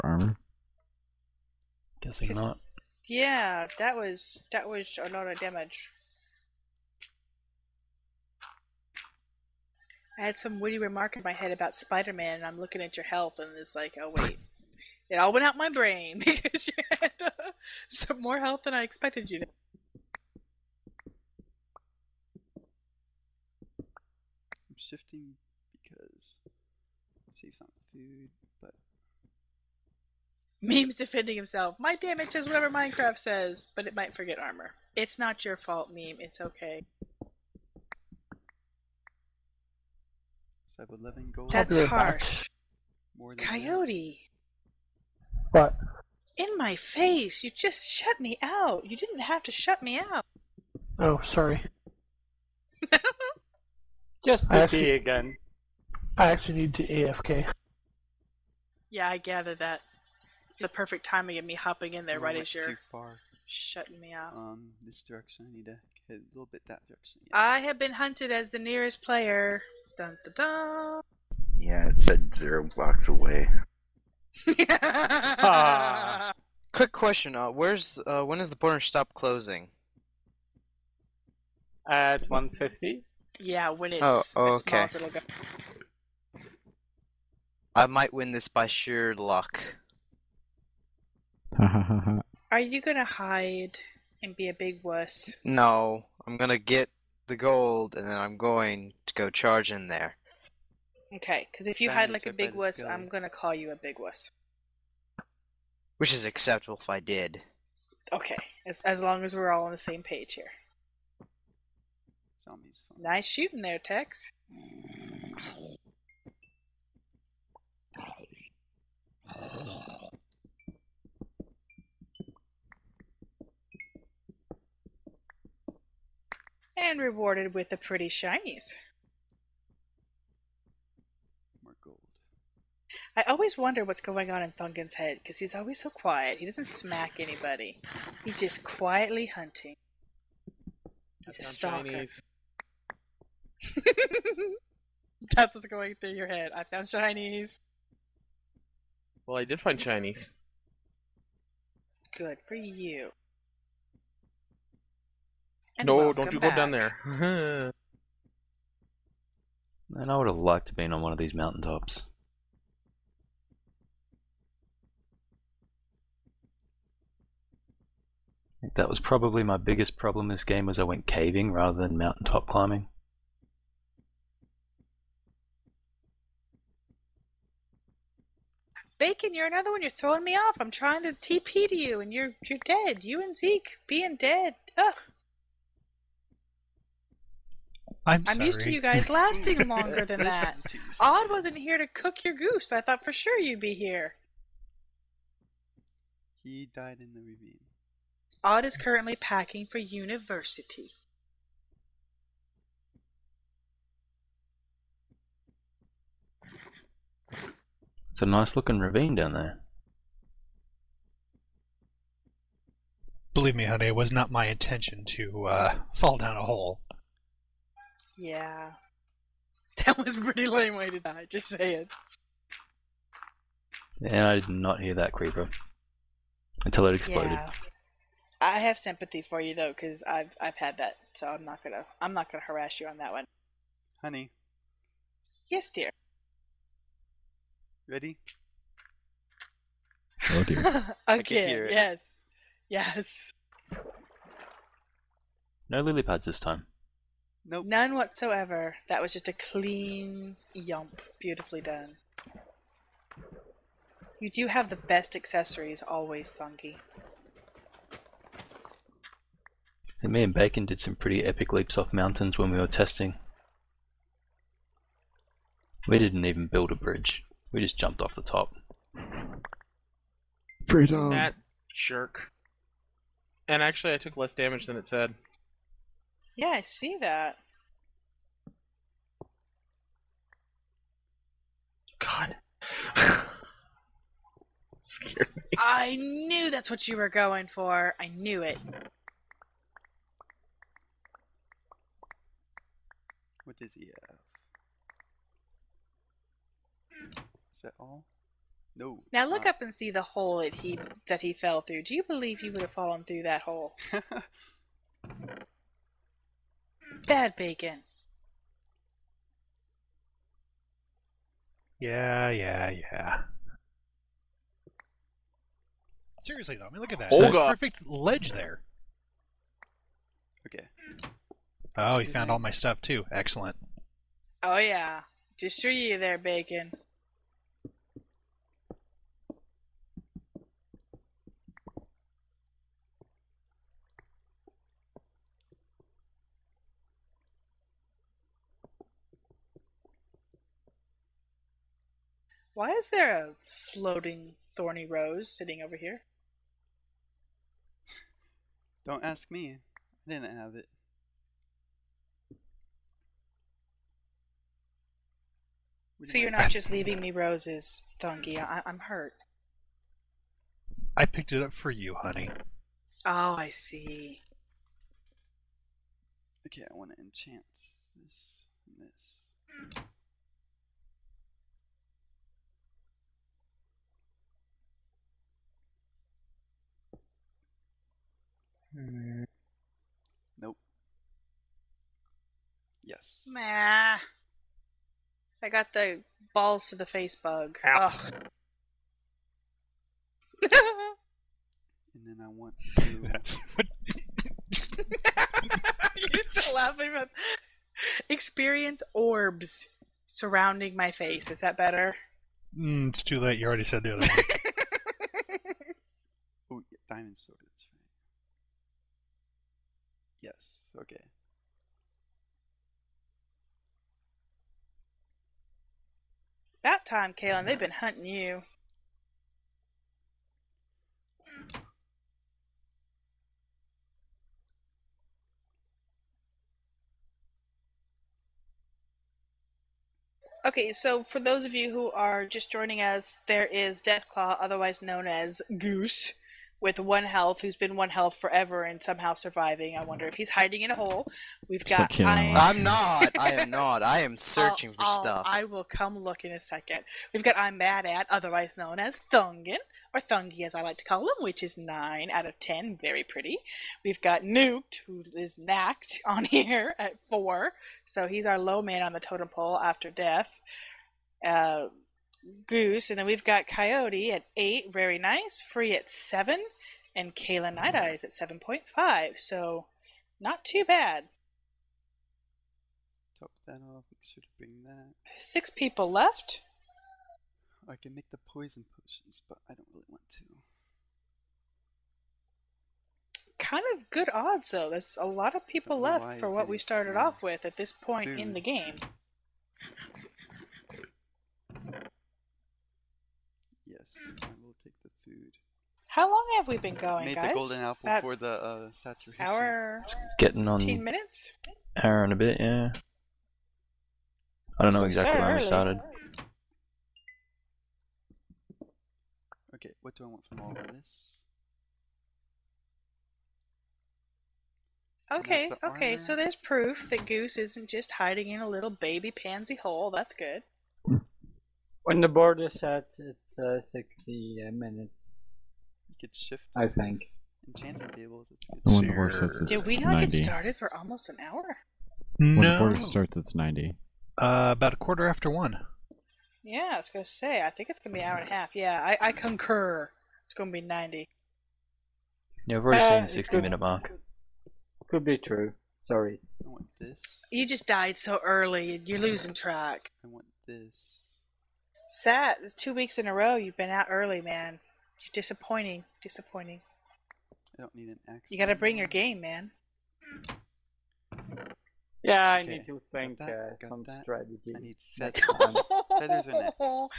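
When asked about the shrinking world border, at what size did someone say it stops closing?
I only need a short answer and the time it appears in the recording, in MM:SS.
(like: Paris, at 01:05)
150, at 01:21.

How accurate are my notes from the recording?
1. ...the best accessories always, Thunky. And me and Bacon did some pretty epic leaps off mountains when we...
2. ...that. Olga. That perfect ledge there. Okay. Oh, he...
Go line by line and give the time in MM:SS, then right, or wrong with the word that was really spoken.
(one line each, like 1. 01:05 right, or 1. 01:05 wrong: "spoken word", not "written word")
1. 04:14 right
2. 05:16 right.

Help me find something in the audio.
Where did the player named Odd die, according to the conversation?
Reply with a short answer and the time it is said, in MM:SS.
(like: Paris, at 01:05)
In the ravine, at 03:16.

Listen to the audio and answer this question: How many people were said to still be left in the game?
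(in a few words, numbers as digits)
6.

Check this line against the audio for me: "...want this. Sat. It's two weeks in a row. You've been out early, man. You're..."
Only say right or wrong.
right.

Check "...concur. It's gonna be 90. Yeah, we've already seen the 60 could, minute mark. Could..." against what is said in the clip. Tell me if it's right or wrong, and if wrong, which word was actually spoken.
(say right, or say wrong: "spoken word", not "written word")
right.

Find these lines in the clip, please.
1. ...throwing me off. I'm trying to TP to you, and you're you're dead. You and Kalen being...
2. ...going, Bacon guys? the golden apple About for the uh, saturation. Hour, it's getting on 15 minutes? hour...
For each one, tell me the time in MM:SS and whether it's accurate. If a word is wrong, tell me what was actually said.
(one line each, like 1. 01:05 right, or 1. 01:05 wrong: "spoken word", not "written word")
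1. 02:59 wrong: "Zeke", not "Kalen"
2. 08:16 wrong: "Made", not "Bacon".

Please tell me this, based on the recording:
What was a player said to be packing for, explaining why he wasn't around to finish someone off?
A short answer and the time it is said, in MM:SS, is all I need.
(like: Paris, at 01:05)
University, at 03:18.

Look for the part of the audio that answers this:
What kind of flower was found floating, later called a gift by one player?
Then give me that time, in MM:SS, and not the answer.
05:43.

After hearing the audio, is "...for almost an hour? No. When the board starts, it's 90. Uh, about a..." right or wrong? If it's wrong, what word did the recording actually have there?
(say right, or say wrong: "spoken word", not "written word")
right.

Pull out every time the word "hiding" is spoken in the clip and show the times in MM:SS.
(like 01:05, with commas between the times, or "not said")
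07:20, 08:37.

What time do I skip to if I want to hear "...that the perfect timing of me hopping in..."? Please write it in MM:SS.
00:59.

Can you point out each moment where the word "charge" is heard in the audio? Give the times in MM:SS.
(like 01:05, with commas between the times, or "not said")
01:39.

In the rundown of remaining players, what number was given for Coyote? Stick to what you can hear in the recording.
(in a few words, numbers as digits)
8.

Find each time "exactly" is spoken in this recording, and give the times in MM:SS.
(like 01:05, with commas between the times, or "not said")
08:24.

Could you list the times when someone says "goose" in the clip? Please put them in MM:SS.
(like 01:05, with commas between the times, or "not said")
03:12, 07:15, 07:42, 08:37.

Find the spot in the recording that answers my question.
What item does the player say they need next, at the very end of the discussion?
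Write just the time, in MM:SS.
09:25.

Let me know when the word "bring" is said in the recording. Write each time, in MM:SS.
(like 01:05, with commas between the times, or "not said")
07:54, 09:18.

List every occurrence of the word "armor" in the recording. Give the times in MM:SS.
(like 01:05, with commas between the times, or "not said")
00:00, 00:34.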